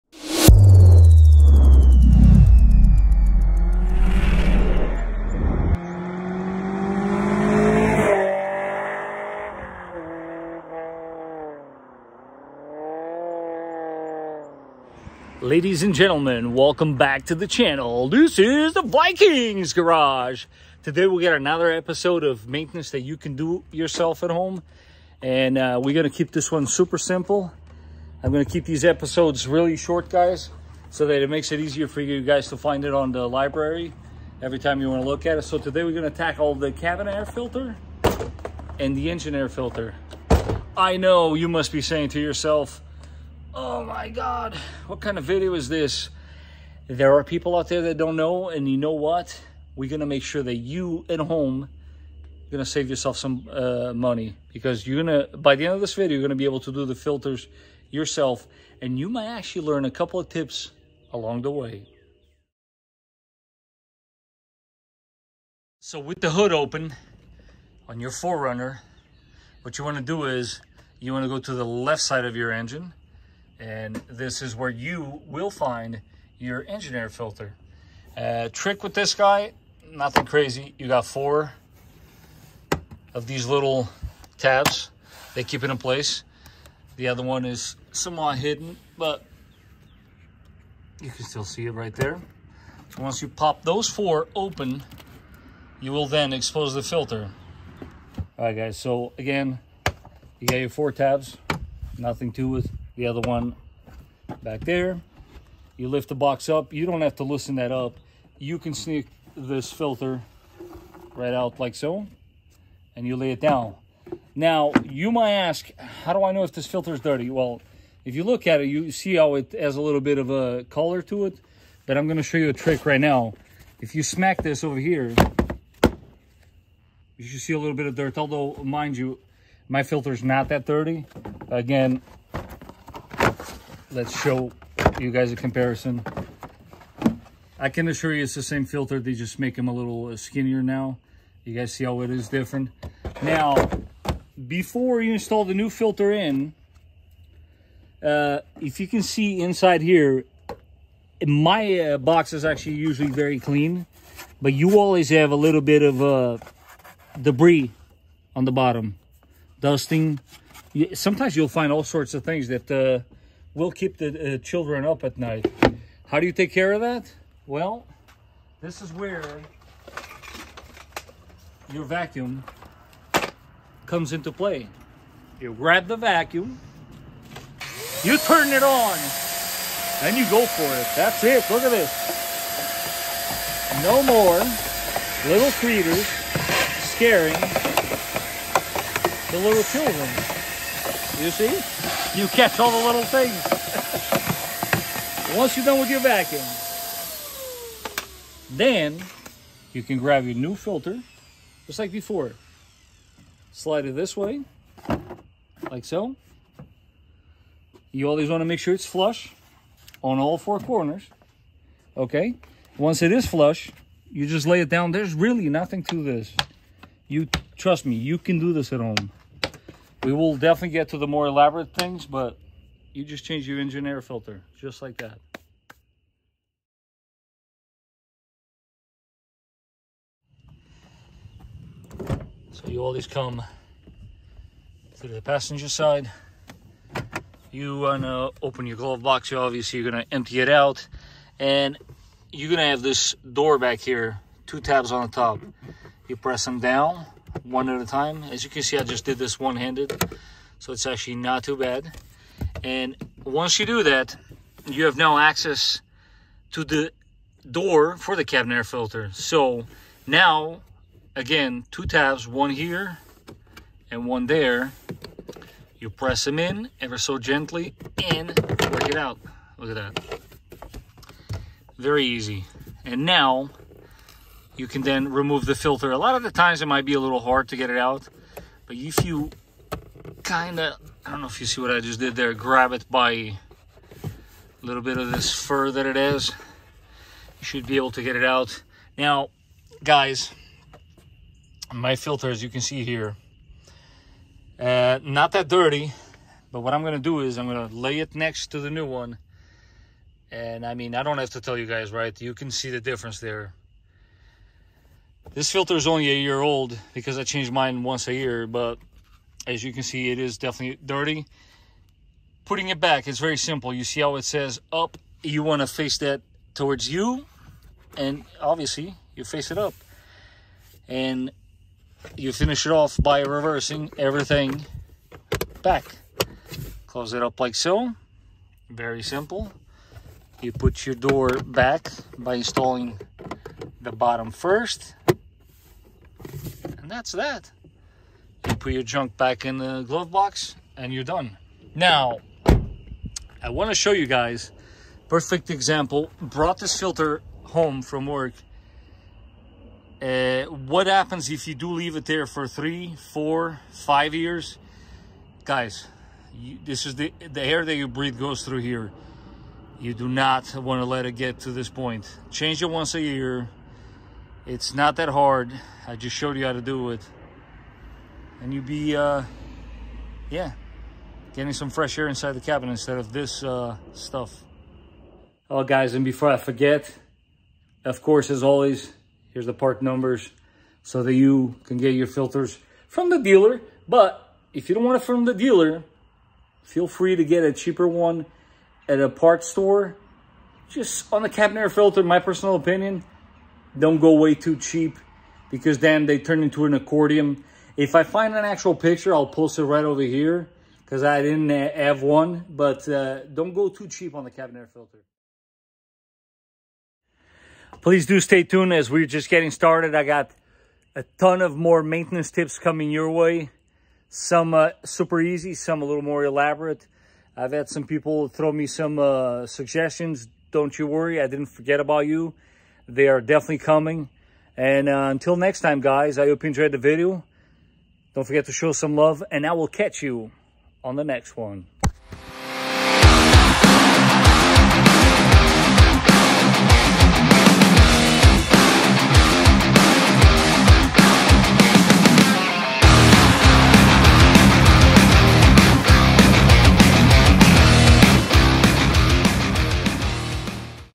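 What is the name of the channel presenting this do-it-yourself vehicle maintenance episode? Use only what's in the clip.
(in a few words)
Vikings Garage.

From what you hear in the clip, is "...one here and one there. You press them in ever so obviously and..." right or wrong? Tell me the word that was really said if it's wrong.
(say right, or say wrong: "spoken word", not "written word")
wrong: "gently", not "obviously".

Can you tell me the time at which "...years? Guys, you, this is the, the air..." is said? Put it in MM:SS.
05:54.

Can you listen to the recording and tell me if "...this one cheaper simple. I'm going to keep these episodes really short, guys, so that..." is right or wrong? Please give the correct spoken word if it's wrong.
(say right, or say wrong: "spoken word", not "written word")
wrong: "super", not "cheaper".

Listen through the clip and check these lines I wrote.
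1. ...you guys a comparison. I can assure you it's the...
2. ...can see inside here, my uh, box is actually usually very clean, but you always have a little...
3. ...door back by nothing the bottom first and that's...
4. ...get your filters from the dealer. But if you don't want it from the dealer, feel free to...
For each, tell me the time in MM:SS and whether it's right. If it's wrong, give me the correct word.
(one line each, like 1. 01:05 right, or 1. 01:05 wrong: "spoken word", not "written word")
1. 02:14 right
2. 02:28 right
3. 05:30 wrong: "installing", not "nothing"
4. 06:21 right.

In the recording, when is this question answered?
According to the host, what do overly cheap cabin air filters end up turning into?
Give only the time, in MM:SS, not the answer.
06:36.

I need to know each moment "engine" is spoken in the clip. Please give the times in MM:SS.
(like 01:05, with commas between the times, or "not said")
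00:39, 01:12, 01:16, 03:43.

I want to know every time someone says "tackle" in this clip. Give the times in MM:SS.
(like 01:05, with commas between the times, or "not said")
00:36.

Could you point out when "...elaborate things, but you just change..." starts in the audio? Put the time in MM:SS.
03:41.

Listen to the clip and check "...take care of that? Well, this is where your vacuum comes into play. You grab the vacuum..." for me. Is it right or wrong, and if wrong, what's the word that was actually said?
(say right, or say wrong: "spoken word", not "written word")
right.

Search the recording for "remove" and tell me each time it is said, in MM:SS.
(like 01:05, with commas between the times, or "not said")
04:35.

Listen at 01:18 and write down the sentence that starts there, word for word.
Uh, trick with this guy, nothing crazy.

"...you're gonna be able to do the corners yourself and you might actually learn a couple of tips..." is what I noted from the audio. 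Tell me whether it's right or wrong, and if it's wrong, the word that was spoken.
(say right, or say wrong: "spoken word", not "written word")
wrong: "filters", not "corners".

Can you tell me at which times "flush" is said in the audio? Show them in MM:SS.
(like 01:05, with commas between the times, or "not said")
03:28, 03:33.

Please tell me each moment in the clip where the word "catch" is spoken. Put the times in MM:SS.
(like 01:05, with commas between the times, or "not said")
03:12, 07:09.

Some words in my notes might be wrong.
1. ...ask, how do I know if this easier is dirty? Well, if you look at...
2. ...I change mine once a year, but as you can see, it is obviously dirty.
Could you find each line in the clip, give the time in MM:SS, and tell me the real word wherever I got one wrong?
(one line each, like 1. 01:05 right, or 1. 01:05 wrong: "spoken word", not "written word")
1. 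01:55 wrong: "filter", not "easier"
2. 05:07 wrong: "definitely", not "obviously".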